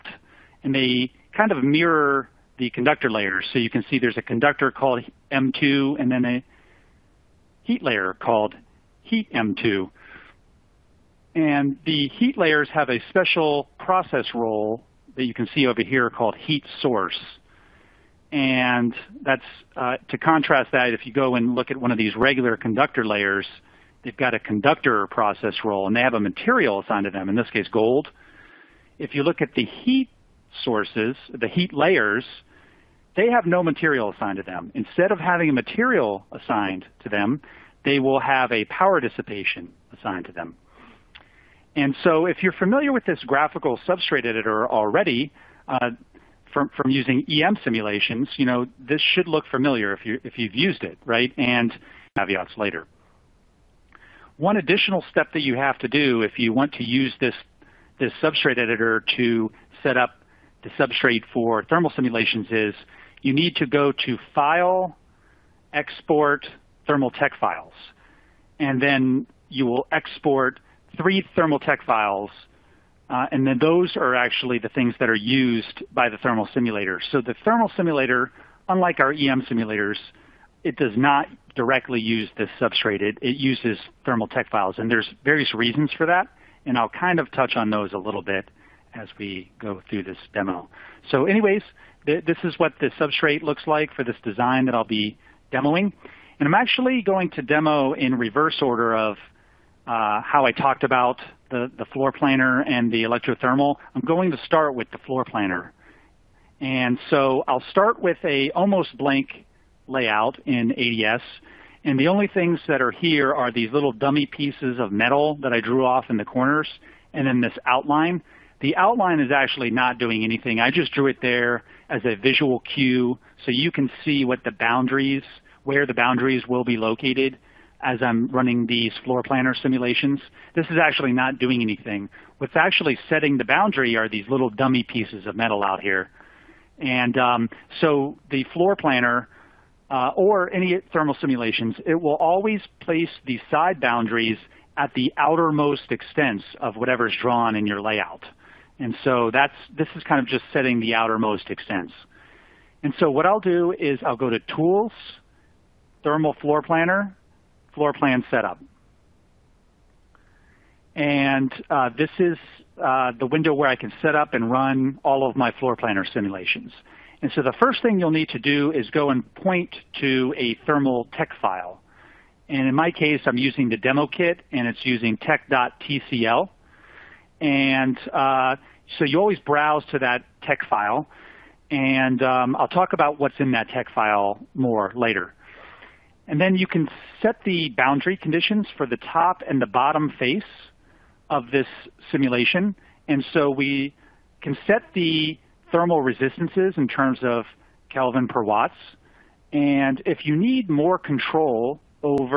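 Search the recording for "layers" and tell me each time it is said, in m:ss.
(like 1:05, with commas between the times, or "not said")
0:03, 0:07, 0:12, 0:23, 0:31.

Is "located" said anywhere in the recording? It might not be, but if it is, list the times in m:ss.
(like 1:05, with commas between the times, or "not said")
2:06.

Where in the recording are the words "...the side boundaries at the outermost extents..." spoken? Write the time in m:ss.
2:23.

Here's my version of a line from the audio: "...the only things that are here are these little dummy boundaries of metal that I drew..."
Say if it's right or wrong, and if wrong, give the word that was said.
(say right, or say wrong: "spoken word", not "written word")
wrong: "pieces", not "boundaries".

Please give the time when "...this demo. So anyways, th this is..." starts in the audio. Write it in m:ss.
1:30.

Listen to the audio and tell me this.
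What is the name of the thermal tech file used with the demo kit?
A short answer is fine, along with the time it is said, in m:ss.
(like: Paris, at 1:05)
tech.tcl, at 2:55.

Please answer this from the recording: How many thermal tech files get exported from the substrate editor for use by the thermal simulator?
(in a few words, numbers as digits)
3.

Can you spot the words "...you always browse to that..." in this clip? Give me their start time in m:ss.
2:59.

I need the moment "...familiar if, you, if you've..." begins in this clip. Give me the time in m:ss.
0:49.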